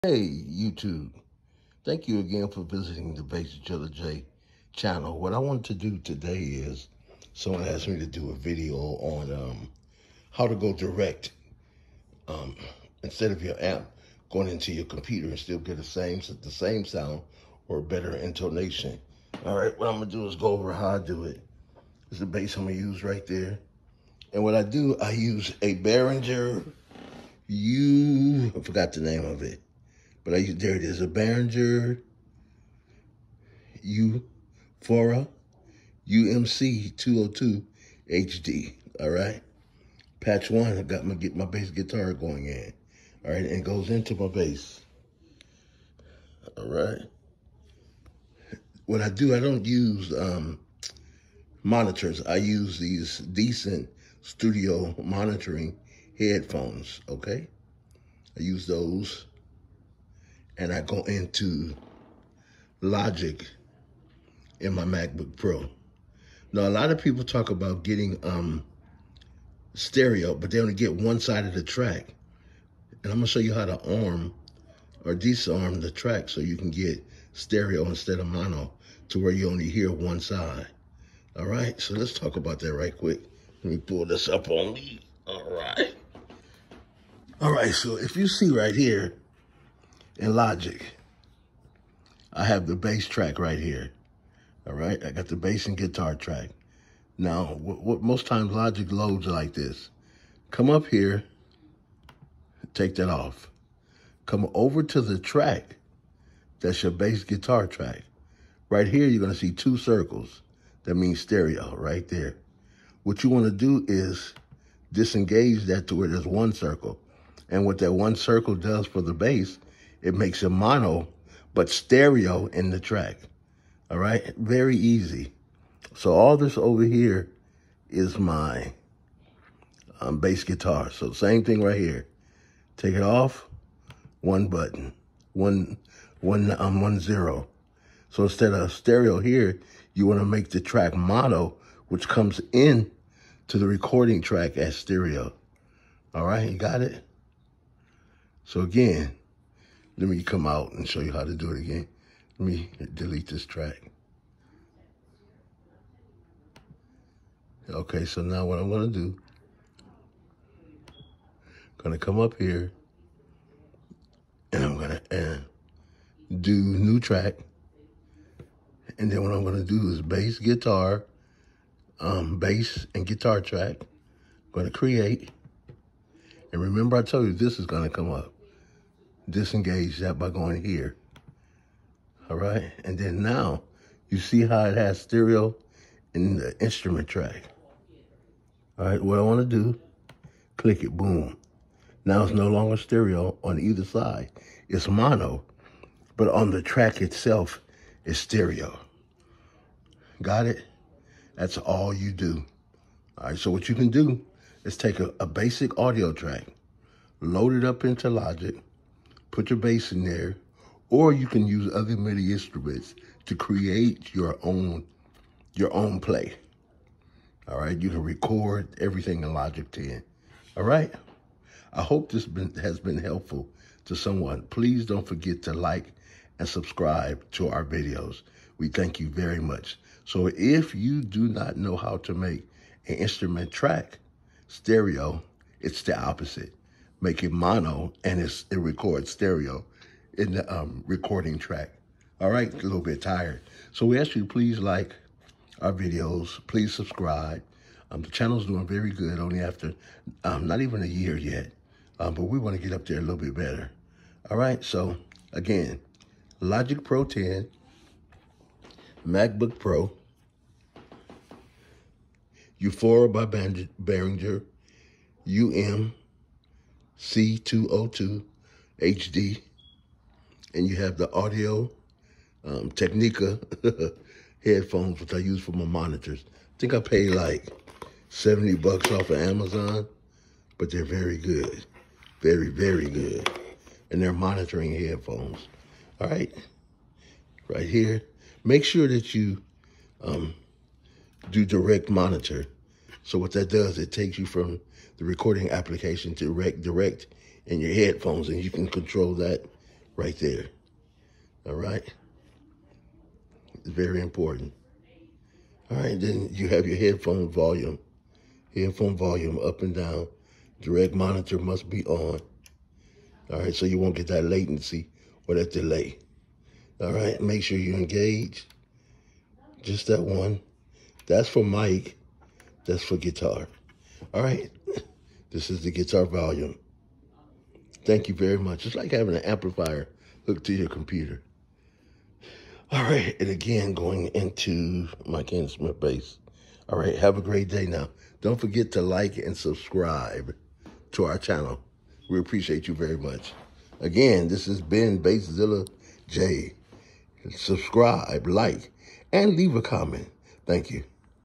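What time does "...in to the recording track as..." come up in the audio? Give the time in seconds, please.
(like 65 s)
142 s.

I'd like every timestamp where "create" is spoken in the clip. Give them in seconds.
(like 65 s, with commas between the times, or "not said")
174 s, 213 s.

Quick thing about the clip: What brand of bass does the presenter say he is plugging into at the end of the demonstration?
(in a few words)
Ken Smith.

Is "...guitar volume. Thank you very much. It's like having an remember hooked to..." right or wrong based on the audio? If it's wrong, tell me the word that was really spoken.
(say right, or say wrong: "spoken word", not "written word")
wrong: "amplifier", not "remember".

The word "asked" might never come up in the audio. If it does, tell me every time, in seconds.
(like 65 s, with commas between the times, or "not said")
7 s.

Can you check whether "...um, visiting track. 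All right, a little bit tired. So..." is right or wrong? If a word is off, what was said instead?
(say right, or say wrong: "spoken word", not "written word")
wrong: "recording", not "visiting".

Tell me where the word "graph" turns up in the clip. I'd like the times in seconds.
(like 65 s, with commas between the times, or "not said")
not said.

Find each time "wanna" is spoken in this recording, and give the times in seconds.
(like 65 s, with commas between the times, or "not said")
113 s, 189 s.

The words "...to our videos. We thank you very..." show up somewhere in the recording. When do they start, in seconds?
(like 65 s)
227 s.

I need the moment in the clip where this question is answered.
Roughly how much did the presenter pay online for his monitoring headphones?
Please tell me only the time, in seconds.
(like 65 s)
278 s.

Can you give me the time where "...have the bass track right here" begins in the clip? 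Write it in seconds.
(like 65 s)
92 s.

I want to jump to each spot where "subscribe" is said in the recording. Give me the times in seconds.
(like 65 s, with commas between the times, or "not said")
226 s, 246 s, 339 s, 347 s.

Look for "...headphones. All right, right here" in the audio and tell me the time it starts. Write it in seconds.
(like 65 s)
284 s.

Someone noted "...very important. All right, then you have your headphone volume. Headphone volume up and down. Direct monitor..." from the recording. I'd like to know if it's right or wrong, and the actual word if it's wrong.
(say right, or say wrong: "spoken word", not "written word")
right.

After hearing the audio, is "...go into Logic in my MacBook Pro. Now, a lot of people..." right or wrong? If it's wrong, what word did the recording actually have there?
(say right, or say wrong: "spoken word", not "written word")
right.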